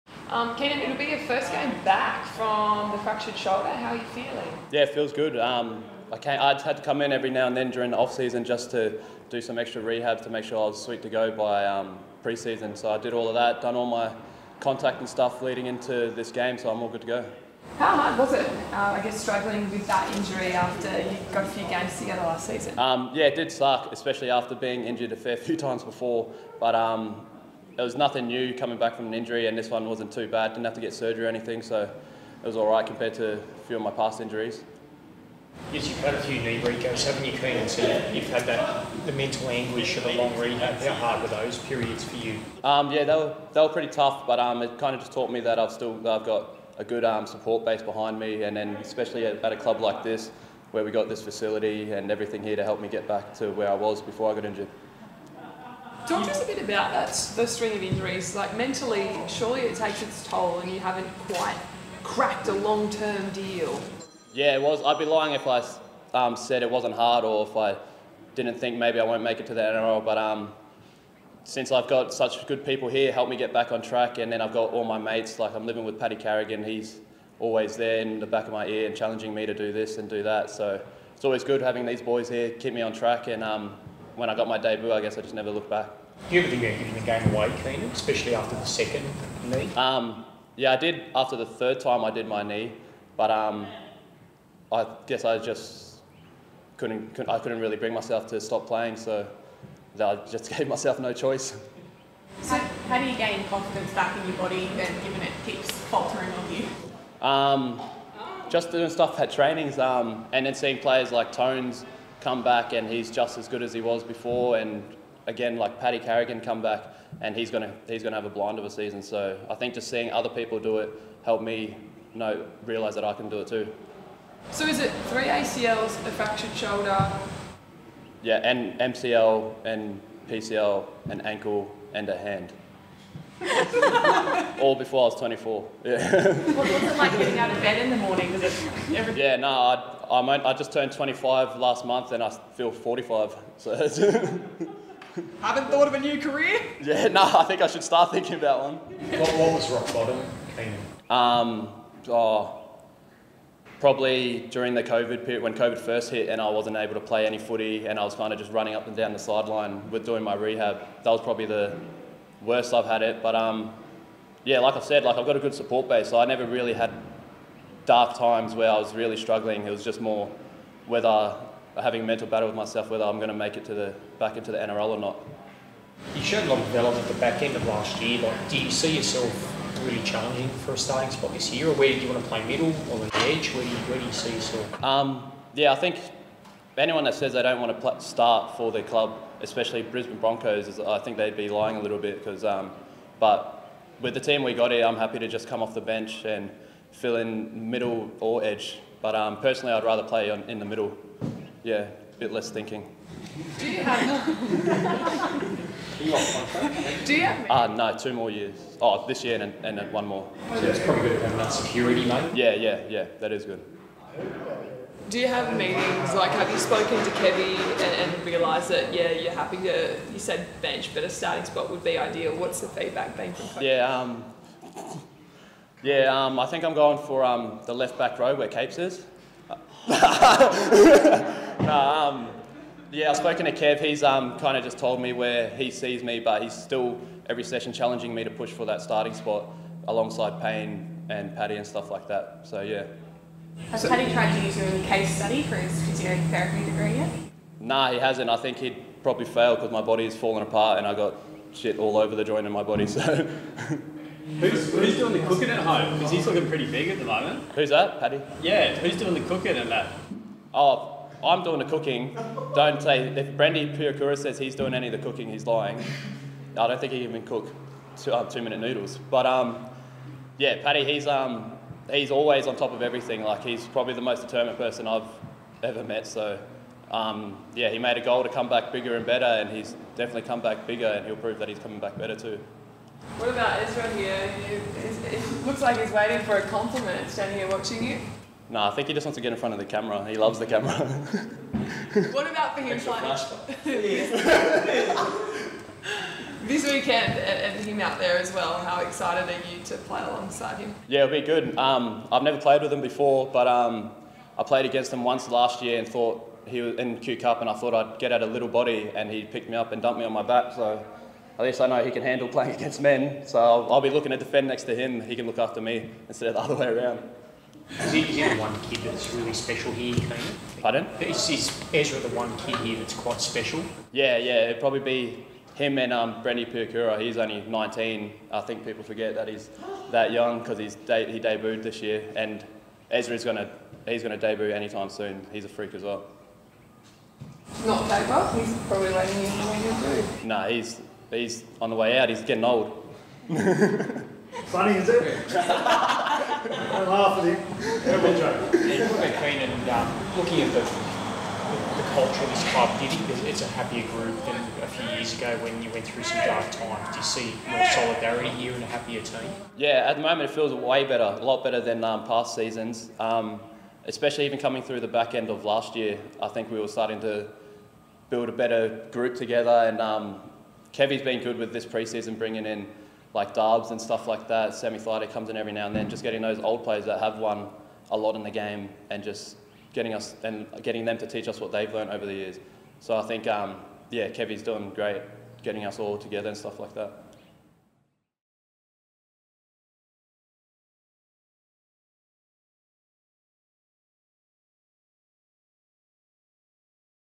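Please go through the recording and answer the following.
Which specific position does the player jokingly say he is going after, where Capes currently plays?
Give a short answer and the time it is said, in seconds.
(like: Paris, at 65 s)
left back row, at 227 s.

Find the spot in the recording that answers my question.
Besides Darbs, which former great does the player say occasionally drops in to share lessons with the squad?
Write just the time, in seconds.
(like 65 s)
374 s.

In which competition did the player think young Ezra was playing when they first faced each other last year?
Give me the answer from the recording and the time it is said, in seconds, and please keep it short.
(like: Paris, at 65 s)
Q Cup, at 306 s.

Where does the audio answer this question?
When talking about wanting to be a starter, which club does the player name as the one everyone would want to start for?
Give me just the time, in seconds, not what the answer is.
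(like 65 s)
189 s.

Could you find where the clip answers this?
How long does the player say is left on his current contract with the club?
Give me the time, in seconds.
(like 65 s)
207 s.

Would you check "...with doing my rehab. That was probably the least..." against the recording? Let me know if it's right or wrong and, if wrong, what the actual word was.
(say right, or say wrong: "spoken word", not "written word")
wrong: "worst", not "least".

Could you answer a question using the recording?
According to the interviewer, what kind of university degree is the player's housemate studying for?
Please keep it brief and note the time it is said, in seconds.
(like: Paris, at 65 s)
physiotherapy, at 245 s.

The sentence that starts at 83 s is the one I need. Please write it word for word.
And um, when I got my debut, I guess I just never looked back.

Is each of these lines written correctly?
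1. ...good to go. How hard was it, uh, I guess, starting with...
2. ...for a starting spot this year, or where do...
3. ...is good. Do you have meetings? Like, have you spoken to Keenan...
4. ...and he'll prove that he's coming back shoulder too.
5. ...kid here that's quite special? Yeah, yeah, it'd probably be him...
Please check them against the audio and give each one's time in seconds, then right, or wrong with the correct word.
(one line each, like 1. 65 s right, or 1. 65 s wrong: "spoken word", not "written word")
1. 16 s wrong: "struggling", not "starting"
2. 180 s right
3. 213 s wrong: "Kevy", not "Keenan"
4. 280 s wrong: "better", not "shoulder"
5. 322 s right.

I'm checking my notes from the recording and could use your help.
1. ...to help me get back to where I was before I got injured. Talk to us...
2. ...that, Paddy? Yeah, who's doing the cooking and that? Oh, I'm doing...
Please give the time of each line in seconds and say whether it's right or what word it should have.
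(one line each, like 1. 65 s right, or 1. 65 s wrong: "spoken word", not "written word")
1. 52 s right
2. 257 s right.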